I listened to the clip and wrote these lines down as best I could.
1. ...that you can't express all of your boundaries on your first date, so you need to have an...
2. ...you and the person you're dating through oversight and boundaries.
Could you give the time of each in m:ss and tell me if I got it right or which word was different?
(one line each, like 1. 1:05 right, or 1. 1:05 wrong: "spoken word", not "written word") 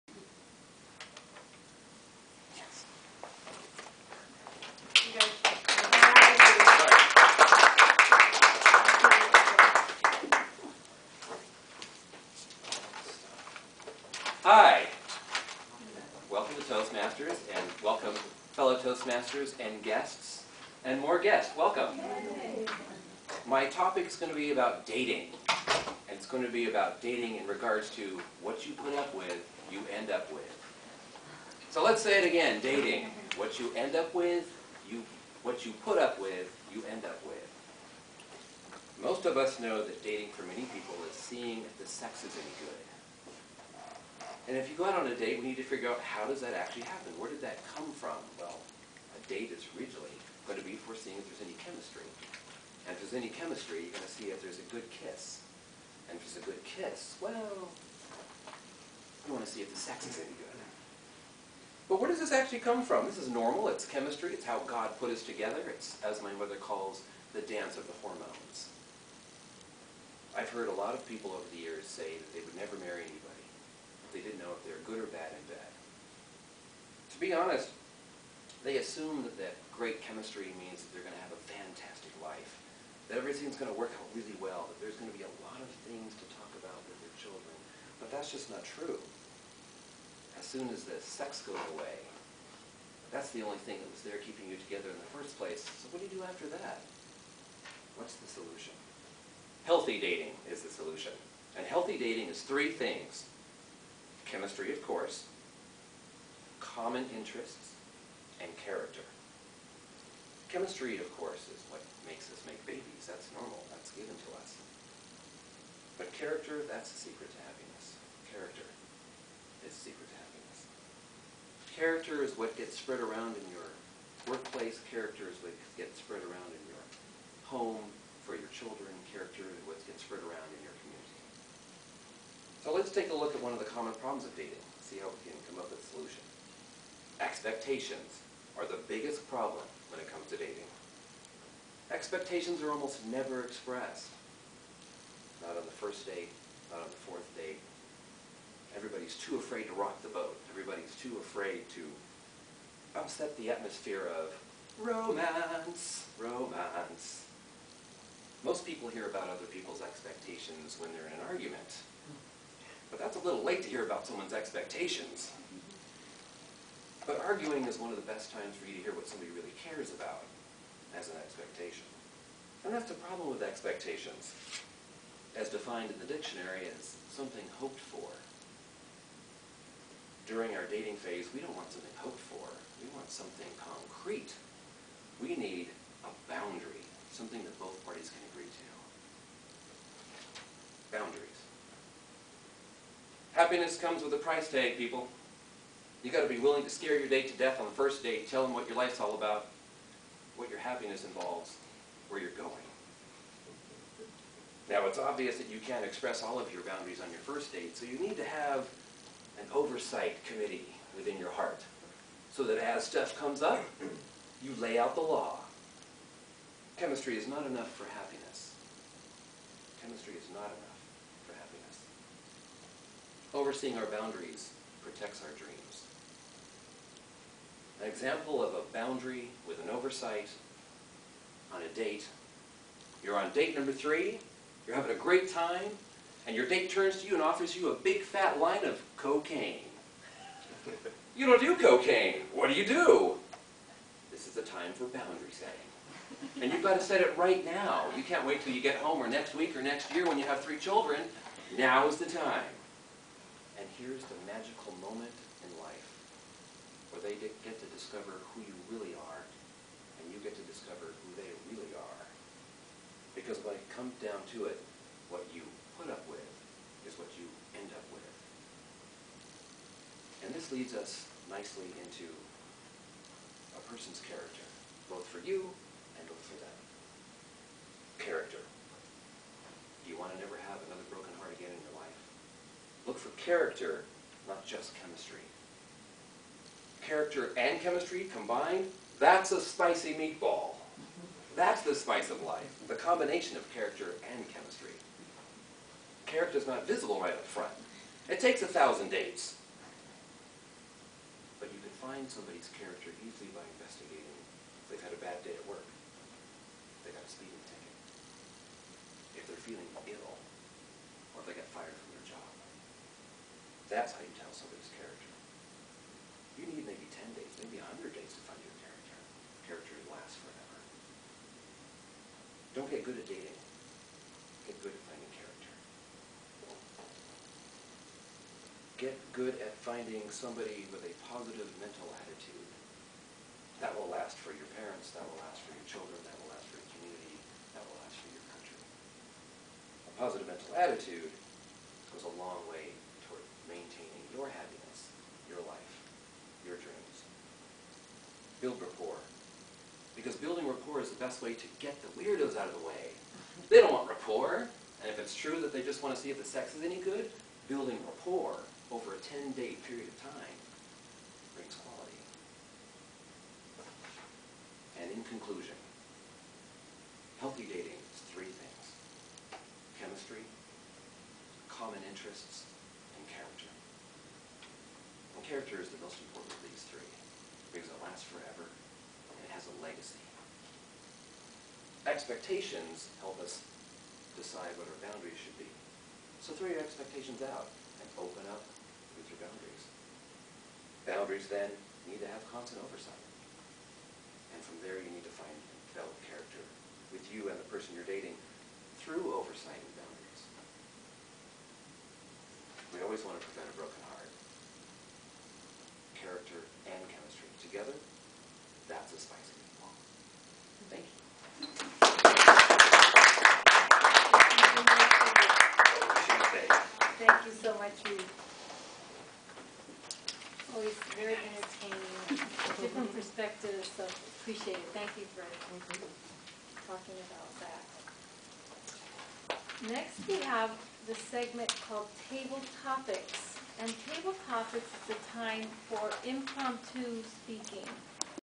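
1. 3:25 right
2. 6:37 right.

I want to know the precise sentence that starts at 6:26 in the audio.
So throw your expectations out and open up with your boundaries.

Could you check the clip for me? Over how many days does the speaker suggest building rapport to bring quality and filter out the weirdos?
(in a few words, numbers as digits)
10.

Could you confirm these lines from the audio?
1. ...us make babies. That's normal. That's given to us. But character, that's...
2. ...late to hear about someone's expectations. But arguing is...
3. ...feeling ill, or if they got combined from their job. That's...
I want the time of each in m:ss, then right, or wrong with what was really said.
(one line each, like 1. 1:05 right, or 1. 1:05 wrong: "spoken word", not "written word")
1. 1:52 right
2. 2:43 right
3. 5:09 wrong: "fired", not "combined".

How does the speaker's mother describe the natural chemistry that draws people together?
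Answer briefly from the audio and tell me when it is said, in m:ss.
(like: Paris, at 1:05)
the dance of the hormones, at 1:07.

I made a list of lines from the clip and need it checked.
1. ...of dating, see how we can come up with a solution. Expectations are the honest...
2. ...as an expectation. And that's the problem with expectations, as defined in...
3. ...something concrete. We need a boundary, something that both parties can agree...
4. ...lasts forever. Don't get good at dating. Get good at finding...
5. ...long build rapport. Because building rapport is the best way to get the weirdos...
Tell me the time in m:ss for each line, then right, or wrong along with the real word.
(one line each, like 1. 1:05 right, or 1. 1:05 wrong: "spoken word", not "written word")
1. 2:14 wrong: "biggest", not "honest"
2. 2:50 right
3. 3:03 right
4. 5:19 right
5. 5:42 right.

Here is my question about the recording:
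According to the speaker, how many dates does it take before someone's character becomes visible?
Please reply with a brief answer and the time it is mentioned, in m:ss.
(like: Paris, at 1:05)
1000, at 4:58.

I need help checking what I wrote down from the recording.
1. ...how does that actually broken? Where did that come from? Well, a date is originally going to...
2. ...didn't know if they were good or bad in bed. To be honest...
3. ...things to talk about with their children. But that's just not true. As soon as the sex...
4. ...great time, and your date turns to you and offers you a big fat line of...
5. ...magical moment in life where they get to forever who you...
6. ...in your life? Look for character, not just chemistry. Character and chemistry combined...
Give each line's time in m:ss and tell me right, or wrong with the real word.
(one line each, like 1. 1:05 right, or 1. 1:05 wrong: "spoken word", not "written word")
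1. 0:46 wrong: "happen", not "broken"
2. 1:14 right
3. 1:25 right
4. 3:54 right
5. 4:14 wrong: "discover", not "forever"
6. 4:41 right.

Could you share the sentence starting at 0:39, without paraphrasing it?
Most of us know that dating for many people is seeing if the sex is any good.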